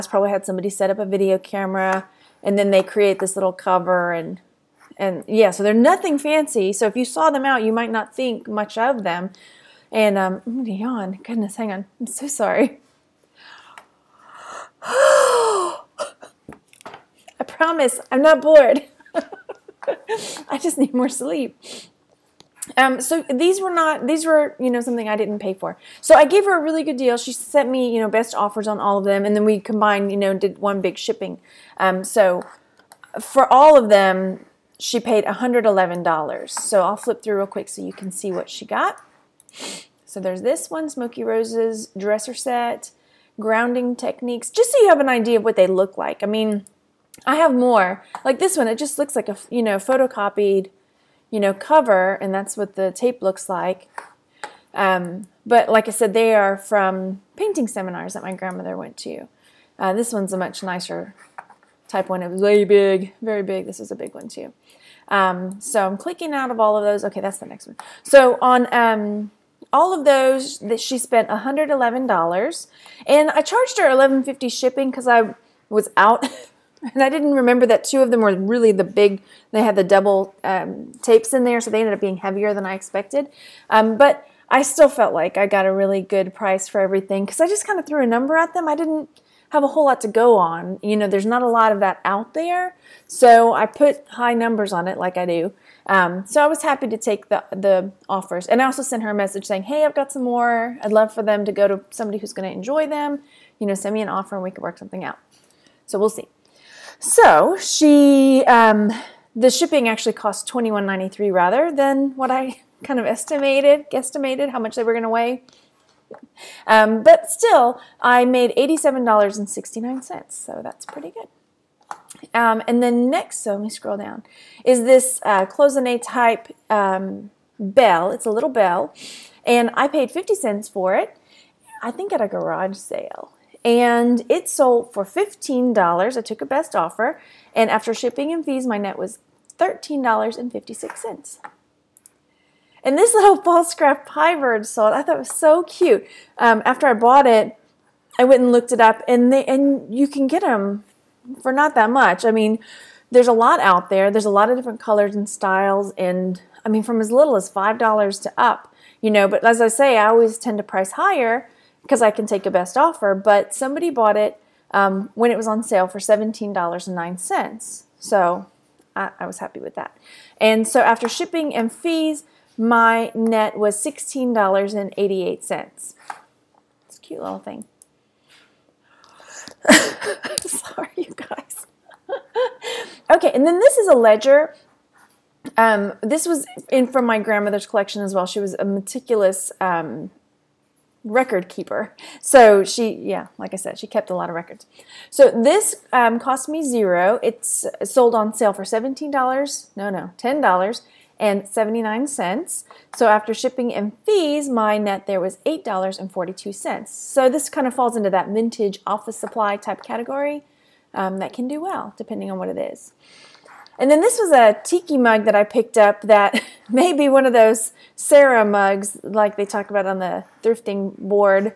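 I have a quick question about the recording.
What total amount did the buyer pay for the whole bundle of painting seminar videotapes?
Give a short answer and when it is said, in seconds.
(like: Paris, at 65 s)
$111, at 34 s.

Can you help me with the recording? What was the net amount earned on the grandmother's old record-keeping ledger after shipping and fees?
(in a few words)
$8.42.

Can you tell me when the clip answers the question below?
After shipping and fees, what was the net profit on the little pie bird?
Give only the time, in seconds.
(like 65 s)
173 s.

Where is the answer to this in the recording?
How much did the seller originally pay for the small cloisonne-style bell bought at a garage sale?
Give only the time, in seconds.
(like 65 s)
130 s.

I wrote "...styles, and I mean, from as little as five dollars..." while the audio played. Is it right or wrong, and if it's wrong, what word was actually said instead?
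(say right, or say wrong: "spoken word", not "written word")
right.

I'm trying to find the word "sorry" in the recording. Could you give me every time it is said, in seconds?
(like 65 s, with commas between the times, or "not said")
12 s, 180 s.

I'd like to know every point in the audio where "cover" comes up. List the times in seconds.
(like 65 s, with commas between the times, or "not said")
3 s, 51 s.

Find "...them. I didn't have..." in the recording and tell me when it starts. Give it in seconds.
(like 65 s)
88 s.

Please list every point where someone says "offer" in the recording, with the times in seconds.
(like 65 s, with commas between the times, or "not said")
28 s, 98 s, 104 s, 136 s, 162 s.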